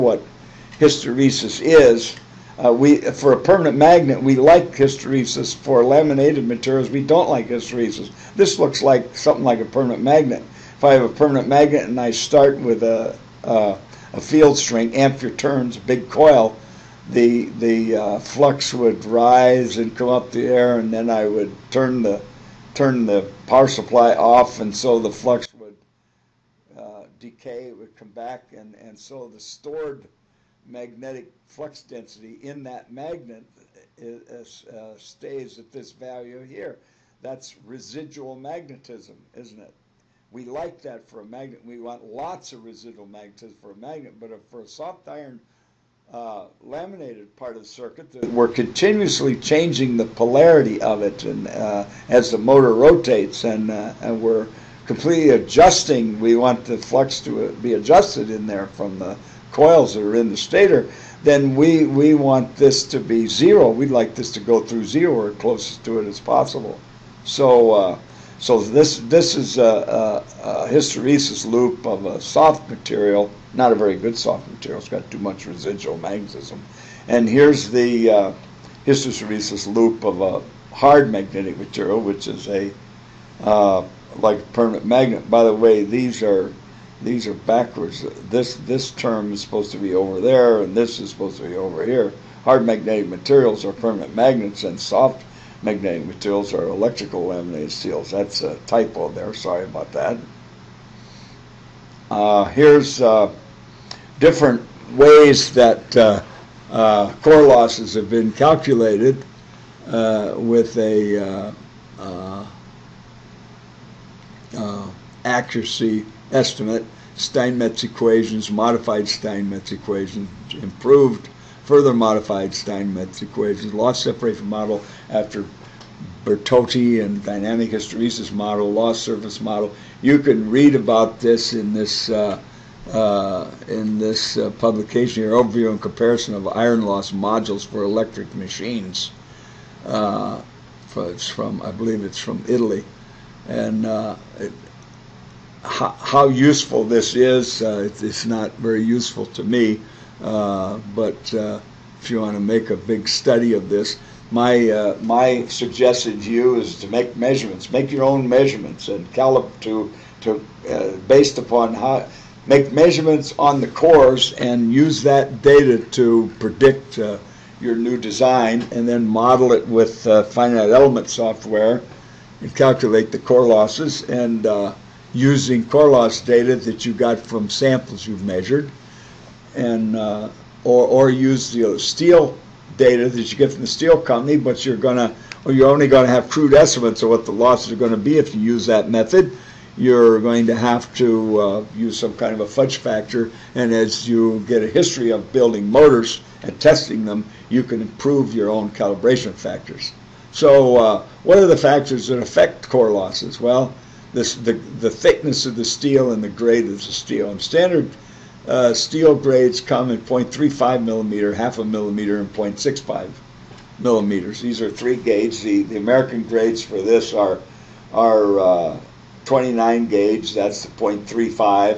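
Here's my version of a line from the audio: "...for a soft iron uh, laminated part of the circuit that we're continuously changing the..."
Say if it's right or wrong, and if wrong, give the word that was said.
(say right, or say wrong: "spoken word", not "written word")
right.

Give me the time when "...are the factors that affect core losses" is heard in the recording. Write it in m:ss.
3:21.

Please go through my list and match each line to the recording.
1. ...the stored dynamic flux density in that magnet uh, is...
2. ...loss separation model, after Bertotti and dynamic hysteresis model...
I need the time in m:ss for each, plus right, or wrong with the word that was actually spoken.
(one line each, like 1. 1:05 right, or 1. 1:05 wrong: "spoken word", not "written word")
1. 0:29 wrong: "magnetic", not "dynamic"
2. 2:03 right.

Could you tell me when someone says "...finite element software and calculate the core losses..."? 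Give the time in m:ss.
2:50.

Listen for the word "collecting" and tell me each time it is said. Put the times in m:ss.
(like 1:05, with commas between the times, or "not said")
not said.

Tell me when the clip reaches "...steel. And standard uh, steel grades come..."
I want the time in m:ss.
3:26.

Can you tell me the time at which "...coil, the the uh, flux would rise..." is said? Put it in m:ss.
0:16.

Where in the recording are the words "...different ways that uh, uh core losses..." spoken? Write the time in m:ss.
1:44.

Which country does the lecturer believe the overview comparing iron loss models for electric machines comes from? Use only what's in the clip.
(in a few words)
Italy.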